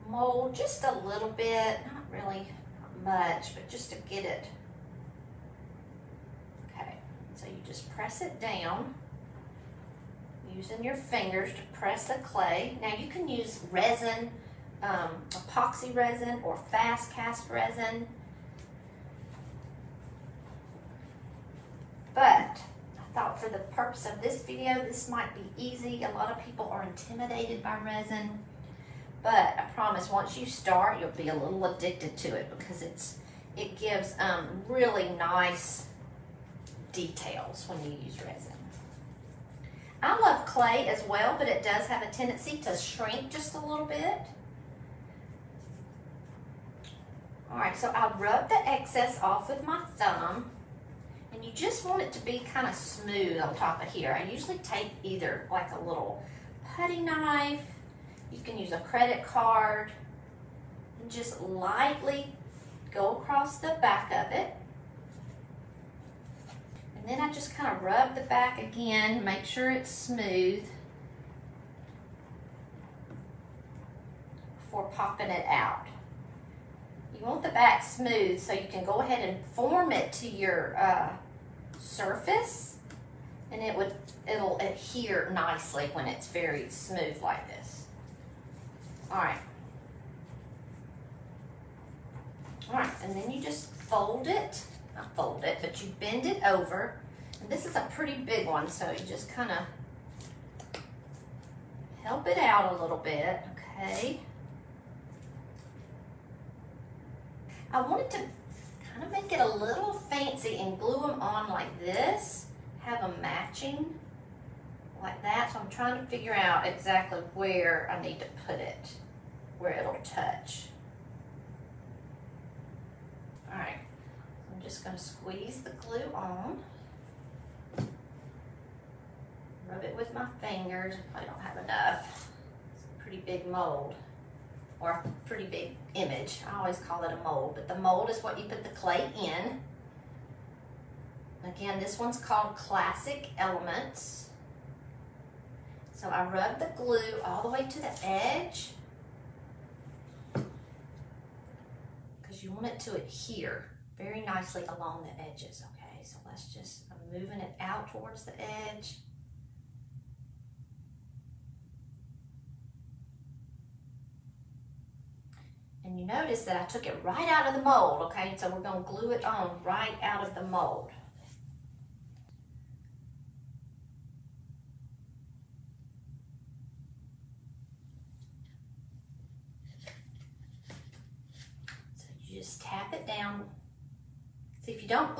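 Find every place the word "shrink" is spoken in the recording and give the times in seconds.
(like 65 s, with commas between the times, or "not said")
42 s.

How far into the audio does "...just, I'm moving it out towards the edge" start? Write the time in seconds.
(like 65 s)
156 s.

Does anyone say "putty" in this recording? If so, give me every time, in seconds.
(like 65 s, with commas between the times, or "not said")
56 s.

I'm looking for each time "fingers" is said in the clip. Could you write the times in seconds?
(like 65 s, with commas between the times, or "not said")
10 s, 130 s.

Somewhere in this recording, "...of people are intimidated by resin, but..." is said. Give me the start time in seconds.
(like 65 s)
26 s.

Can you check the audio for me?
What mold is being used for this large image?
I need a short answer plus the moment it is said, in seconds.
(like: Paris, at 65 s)
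Classic Elements, at 142 s.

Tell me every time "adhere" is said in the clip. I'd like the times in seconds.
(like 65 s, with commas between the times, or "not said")
84 s, 152 s.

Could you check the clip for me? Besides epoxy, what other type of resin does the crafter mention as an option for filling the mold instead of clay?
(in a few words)
Fast cast resin.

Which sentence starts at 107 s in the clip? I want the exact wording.
I wanted to kind of make it a little fancy and glue them on like this, have them matching like that.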